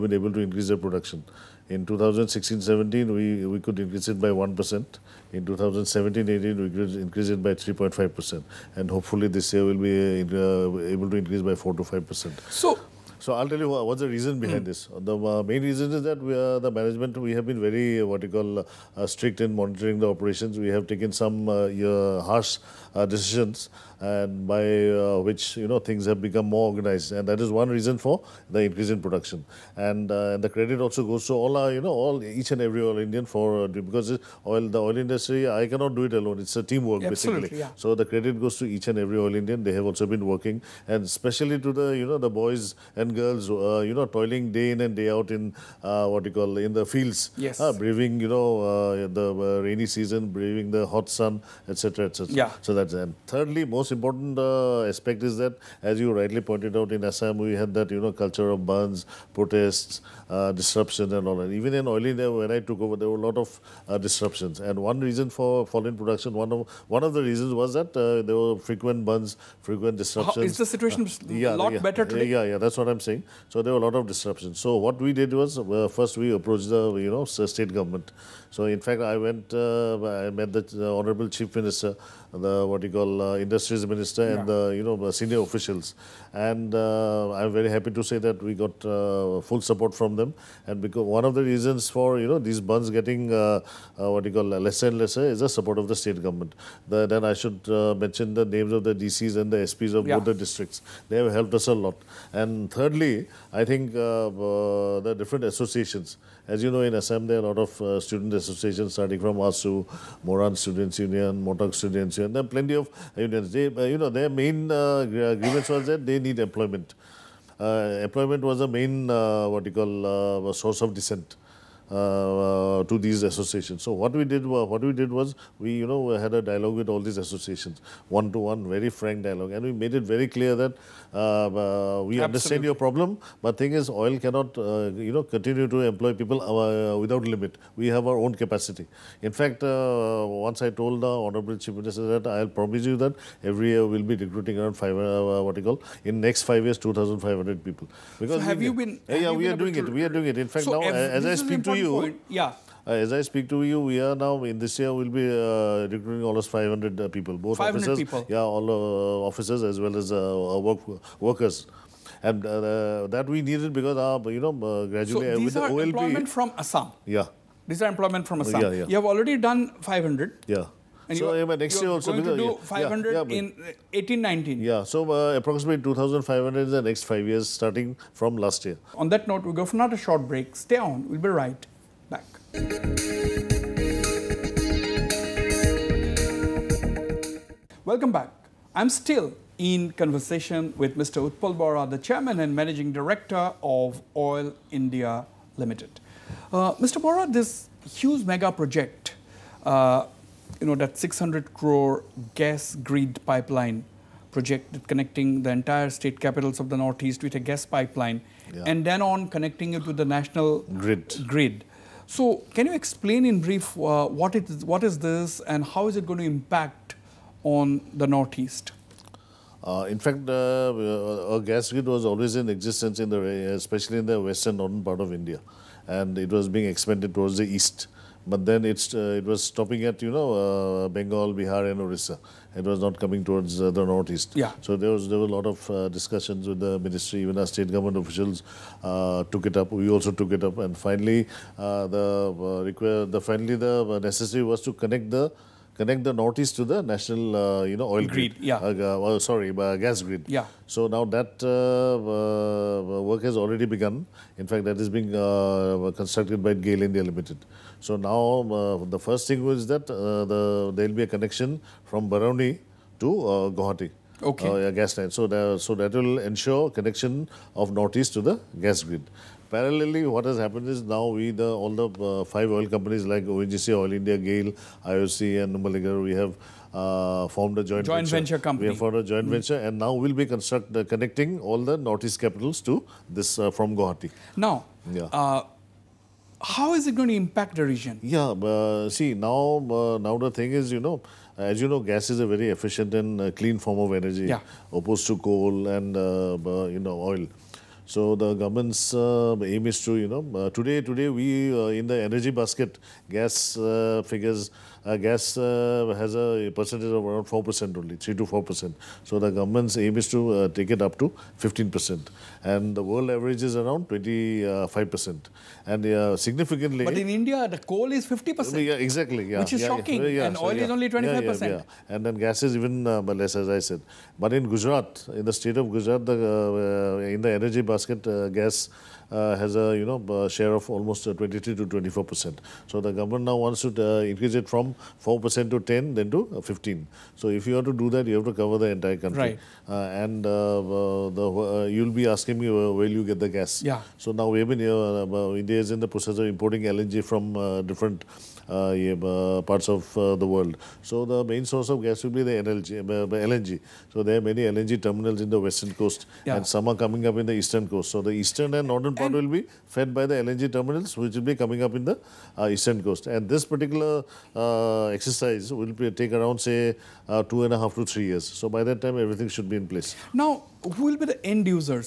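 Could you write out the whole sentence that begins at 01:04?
And one reason for falling production, one of one of the reasons was that uh, there were frequent bandhs, frequent disruptions.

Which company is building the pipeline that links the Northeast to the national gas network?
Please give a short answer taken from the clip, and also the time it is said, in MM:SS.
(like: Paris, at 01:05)
GAIL India Limited, at 04:16.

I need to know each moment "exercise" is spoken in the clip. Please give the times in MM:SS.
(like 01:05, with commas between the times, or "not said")
06:04.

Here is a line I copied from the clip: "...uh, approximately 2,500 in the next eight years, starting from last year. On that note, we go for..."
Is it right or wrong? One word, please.
wrong.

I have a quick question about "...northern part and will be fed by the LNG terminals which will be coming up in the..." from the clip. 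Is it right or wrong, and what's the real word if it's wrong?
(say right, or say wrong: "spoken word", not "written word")
right.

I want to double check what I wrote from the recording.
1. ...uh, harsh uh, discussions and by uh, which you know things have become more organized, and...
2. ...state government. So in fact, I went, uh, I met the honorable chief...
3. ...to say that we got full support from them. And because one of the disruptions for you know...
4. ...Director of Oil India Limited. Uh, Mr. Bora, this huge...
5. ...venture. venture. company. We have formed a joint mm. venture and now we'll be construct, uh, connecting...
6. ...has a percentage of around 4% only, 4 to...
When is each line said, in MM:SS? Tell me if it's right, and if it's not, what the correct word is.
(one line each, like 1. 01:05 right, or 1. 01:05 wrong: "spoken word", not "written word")
1. 00:21 wrong: "decisions", not "discussions"
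2. 01:17 right
3. 01:27 wrong: "reasons", not "disruptions"
4. 03:12 right
5. 04:38 right
6. 05:05 wrong: "3", not "4".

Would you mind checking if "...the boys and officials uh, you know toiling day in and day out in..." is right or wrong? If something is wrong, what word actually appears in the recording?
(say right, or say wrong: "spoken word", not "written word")
wrong: "girls", not "officials".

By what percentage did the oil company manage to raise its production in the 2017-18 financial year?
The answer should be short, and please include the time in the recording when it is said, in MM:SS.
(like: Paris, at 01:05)
3.5%, at 00:07.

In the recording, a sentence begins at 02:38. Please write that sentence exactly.
yeah, all uh, officers as well as uh, uh, work, workers.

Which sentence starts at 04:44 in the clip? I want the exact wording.
Now, yeah uh, how is it going to impact the region?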